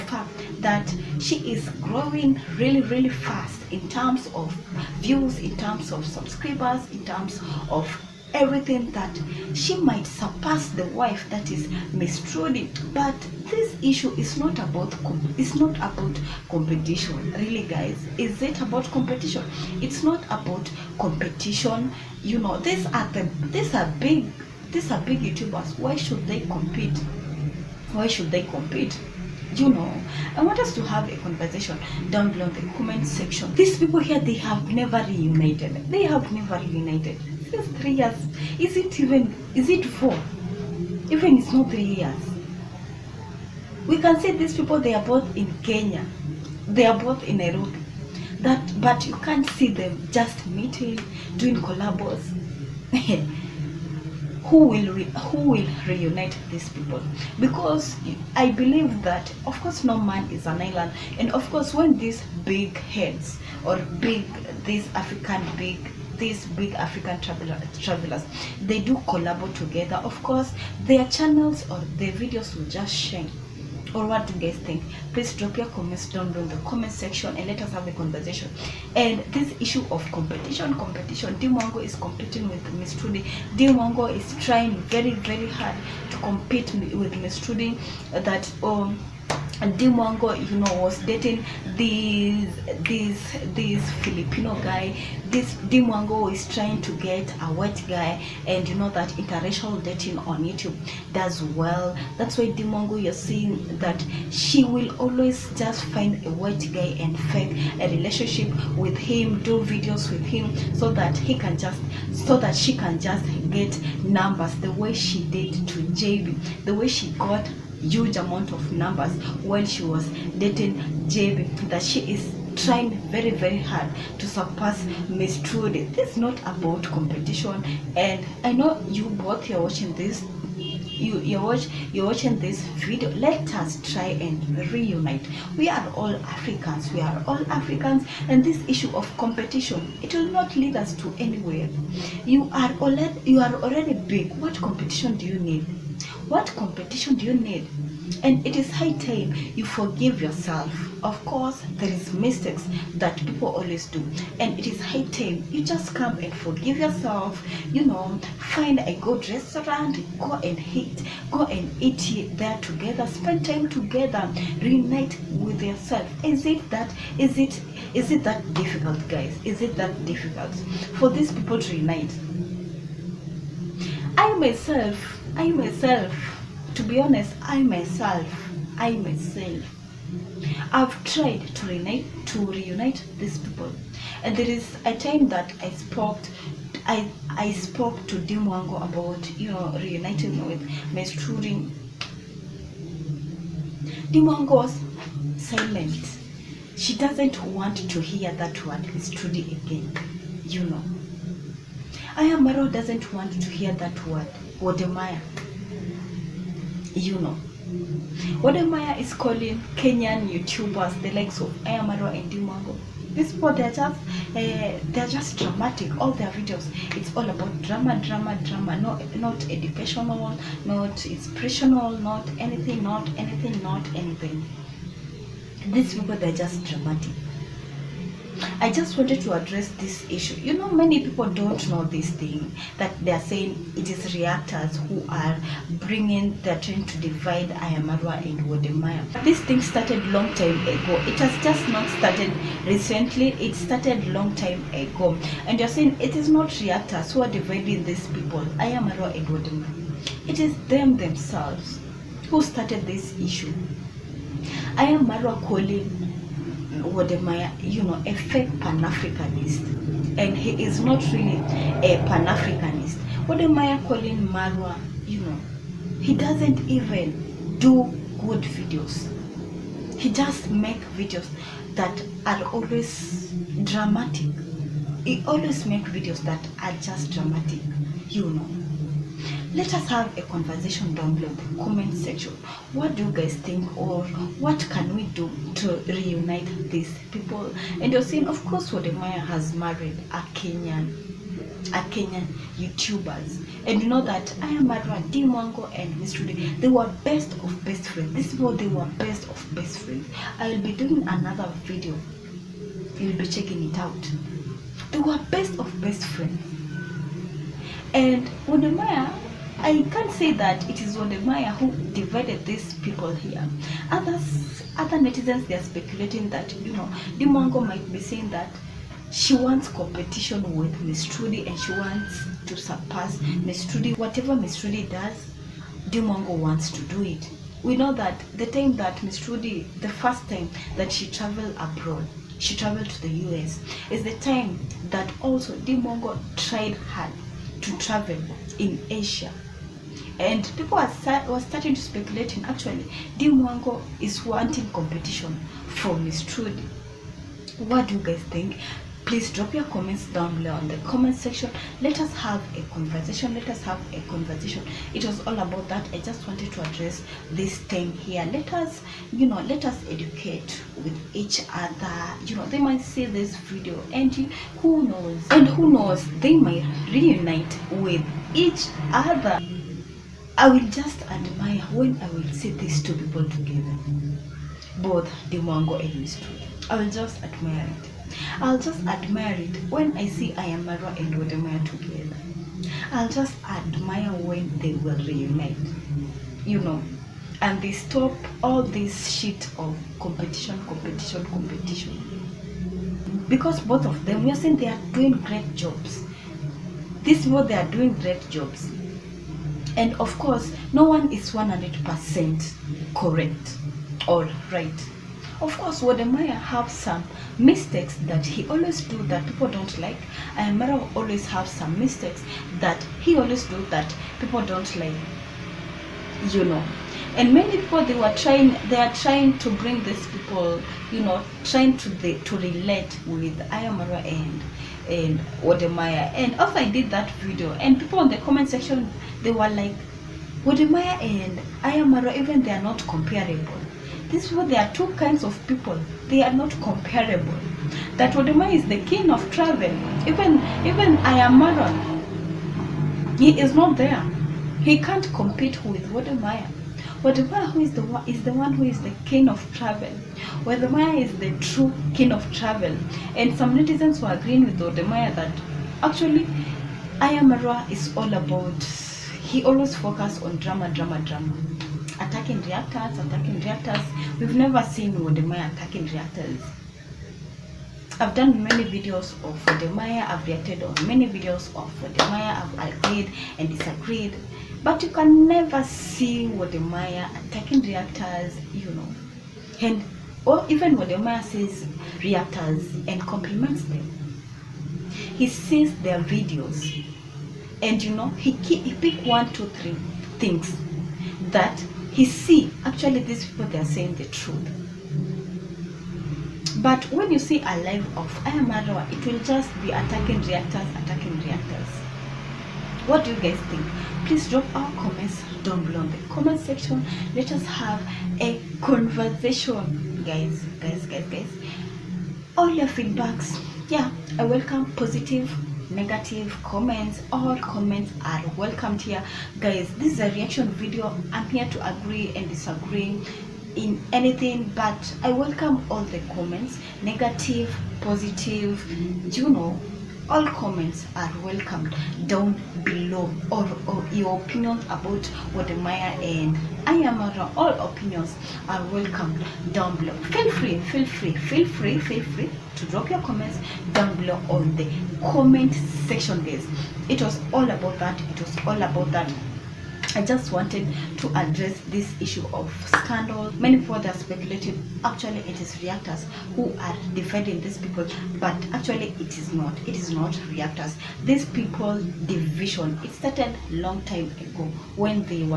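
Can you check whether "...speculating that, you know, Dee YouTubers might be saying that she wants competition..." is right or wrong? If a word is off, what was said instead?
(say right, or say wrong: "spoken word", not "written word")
wrong: "Mwango", not "YouTubers".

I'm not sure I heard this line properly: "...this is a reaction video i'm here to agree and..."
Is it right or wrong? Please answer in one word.
right.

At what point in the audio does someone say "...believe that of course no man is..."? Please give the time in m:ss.
0:58.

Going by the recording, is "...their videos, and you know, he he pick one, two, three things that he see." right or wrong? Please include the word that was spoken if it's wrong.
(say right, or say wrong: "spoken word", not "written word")
right.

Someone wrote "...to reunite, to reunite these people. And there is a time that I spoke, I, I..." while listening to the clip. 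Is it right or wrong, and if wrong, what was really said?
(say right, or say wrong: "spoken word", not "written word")
right.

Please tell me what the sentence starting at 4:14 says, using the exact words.
Ayamarwa calling Wodemaya, you know, a fake Pan-Africanist.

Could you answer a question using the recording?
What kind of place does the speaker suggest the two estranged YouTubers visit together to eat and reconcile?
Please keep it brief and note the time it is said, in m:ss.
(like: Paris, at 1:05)
A good restaurant, at 2:38.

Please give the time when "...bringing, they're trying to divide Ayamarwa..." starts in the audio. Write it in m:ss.
3:55.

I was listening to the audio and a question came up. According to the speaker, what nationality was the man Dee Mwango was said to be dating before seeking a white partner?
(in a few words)
Filipino.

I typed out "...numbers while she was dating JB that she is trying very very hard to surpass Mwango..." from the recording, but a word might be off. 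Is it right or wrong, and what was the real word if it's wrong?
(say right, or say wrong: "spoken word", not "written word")
wrong: "Miss", not "Mwango".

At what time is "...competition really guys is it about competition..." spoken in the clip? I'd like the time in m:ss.
0:16.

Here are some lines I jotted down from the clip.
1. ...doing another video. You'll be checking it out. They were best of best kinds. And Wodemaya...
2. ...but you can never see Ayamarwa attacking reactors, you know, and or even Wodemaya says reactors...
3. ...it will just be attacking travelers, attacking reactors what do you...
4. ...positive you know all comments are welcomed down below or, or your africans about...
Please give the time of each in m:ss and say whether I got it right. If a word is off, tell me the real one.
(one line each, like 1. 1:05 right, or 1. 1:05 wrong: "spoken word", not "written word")
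1. 5:00 wrong: "friends", not "kinds"
2. 7:54 wrong: "Wodemaya", not "Ayamarwa"
3. 8:18 wrong: "reactors", not "travelers"
4. 8:47 wrong: "opinions", not "africans".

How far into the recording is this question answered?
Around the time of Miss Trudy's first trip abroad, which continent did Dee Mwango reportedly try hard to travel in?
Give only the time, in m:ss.
5:38.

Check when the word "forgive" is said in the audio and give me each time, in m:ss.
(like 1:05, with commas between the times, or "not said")
2:29, 2:36.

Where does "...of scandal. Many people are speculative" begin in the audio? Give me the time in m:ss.
9:12.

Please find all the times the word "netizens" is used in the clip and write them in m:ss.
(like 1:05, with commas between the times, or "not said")
5:14, 7:33.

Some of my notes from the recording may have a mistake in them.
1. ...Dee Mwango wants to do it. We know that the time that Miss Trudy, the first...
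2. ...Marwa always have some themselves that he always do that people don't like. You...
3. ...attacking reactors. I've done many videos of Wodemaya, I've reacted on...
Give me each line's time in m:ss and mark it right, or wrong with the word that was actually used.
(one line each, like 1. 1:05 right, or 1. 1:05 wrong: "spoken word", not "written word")
1. 5:25 right
2. 6:50 wrong: "mistakes", not "themselves"
3. 7:45 right.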